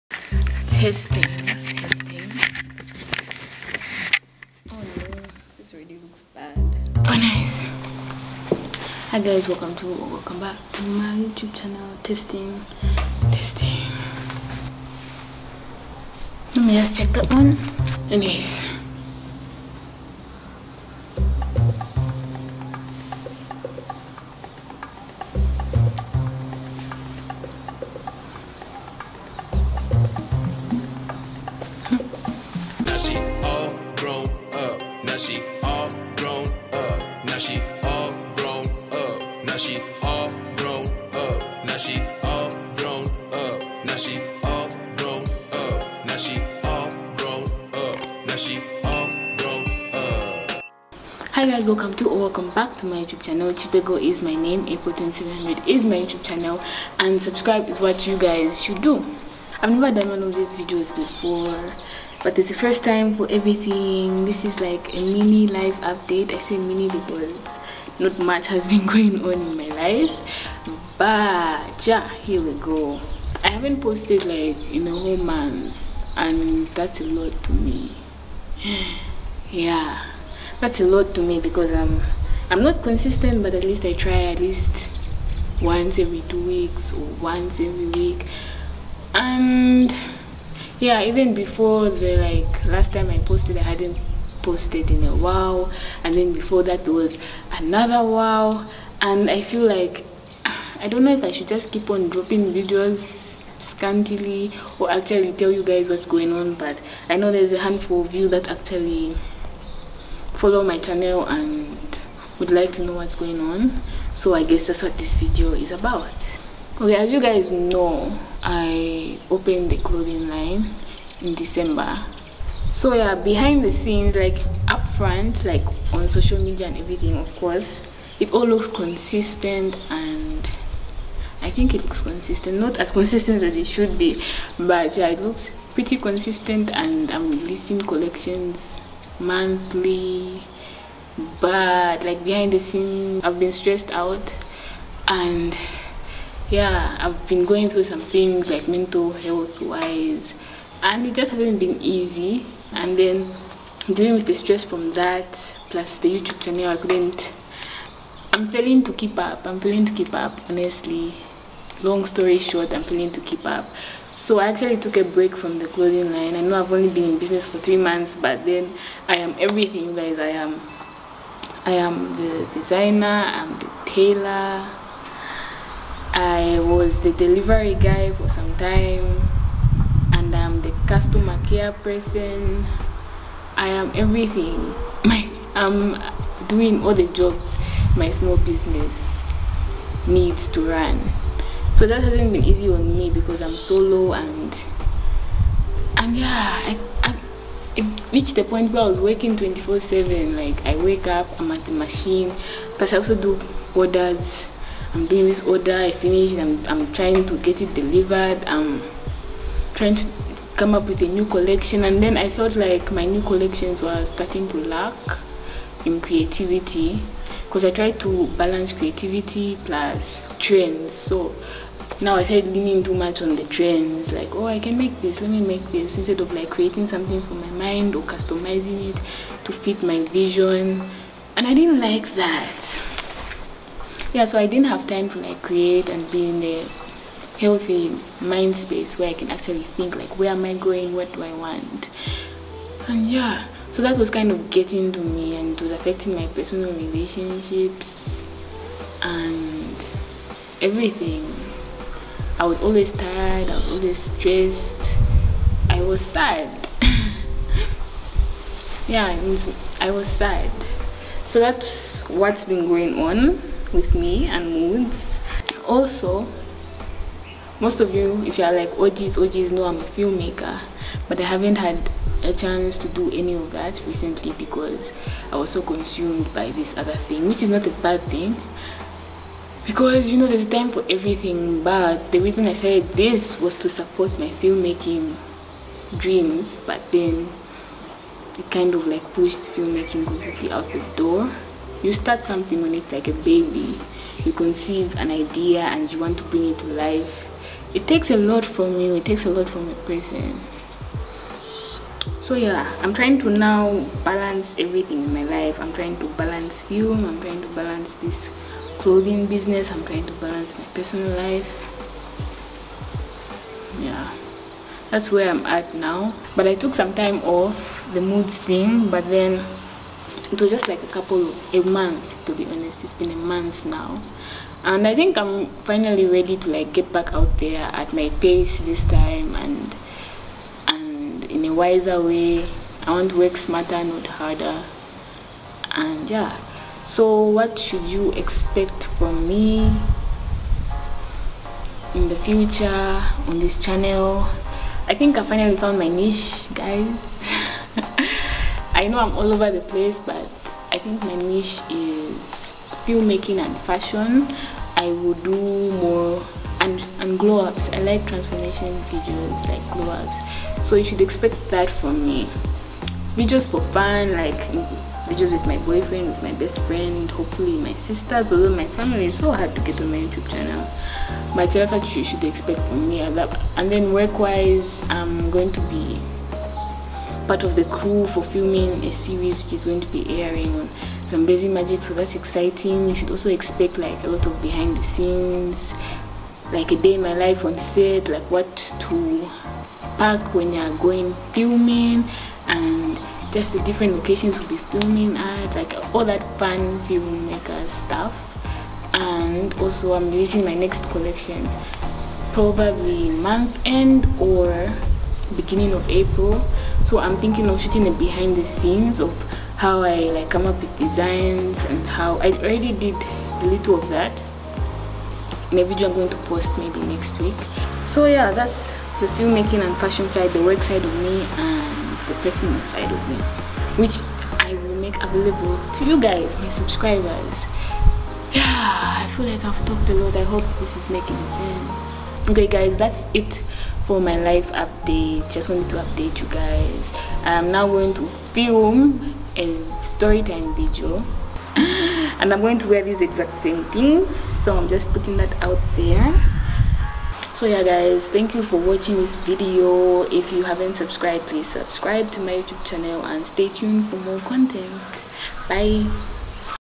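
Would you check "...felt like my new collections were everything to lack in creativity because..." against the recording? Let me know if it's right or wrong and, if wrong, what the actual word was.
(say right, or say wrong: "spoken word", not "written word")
wrong: "starting", not "everything".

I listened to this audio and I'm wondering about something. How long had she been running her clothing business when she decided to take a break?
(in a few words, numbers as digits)
three months.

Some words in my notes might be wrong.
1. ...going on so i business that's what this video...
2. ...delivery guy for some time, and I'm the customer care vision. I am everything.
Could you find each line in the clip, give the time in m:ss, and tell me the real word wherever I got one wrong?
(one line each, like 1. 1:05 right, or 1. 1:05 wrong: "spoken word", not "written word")
1. 1:53 wrong: "guess", not "business"
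2. 2:57 wrong: "person", not "vision".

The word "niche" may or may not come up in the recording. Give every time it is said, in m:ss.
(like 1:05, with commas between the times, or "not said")
5:45, 5:51.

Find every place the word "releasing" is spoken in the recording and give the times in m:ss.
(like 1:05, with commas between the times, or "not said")
2:17, 6:40.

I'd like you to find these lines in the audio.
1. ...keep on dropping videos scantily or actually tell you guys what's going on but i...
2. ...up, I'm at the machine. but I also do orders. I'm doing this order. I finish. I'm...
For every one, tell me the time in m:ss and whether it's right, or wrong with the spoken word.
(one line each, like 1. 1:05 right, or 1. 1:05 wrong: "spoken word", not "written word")
1. 1:41 right
2. 3:21 right.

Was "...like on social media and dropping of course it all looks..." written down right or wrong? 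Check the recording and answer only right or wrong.
wrong.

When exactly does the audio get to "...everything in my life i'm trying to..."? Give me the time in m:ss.
5:04.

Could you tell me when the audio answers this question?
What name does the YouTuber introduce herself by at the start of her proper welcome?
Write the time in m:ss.
0:53.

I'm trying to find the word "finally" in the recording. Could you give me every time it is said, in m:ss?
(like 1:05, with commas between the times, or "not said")
5:25, 5:45.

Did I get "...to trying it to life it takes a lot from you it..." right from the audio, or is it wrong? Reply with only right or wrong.
wrong.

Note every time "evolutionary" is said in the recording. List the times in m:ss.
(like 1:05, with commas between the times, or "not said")
not said.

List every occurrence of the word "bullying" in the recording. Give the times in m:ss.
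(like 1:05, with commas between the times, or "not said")
not said.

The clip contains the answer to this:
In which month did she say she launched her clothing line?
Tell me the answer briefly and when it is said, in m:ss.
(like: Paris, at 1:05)
December, at 2:01.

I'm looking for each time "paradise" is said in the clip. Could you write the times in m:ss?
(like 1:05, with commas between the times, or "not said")
not said.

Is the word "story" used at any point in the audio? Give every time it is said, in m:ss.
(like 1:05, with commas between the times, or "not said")
2:42, 7:19.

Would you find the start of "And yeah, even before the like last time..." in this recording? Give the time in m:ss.
1:29.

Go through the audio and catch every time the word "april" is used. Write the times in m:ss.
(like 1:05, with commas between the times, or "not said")
0:54, 6:45.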